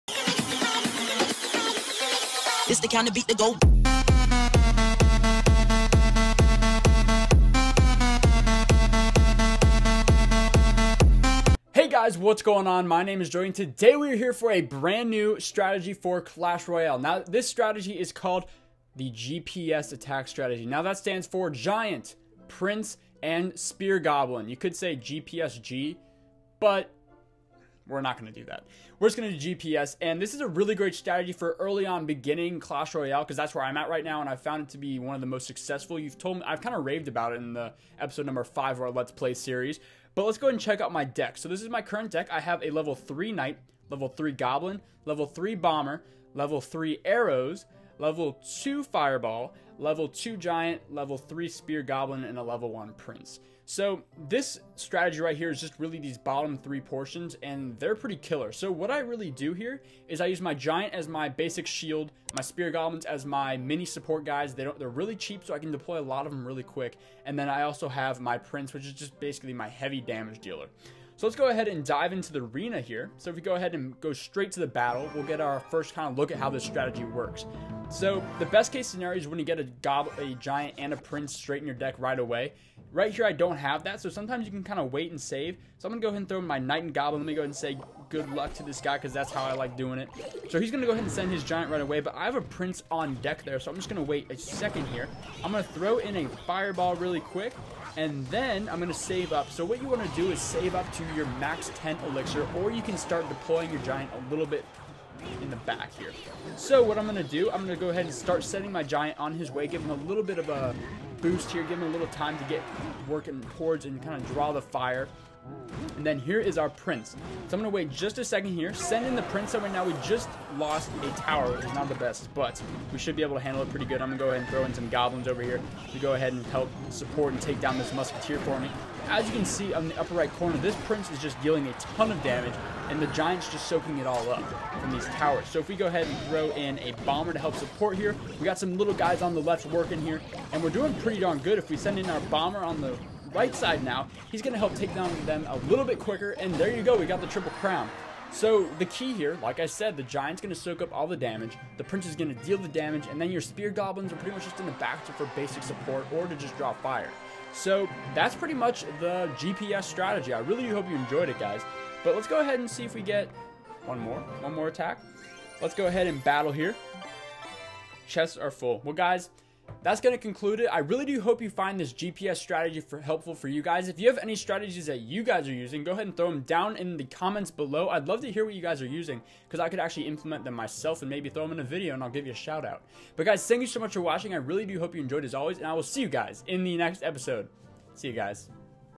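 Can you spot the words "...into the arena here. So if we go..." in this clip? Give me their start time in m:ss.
1:12.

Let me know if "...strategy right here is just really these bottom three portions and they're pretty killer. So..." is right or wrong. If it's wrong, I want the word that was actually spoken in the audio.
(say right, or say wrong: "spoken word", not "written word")
right.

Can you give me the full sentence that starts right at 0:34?
And I found it to be one of the most successful.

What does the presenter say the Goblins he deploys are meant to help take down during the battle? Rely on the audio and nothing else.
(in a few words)
musketeer.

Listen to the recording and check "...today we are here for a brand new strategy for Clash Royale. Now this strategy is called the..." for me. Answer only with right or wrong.
right.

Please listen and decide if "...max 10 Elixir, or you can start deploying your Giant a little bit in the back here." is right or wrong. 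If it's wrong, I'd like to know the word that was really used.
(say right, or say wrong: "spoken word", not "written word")
right.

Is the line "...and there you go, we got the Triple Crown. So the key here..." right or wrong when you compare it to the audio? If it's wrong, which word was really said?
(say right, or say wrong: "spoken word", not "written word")
right.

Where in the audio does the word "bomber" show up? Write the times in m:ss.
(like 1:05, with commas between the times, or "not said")
0:45, 2:17, 2:22.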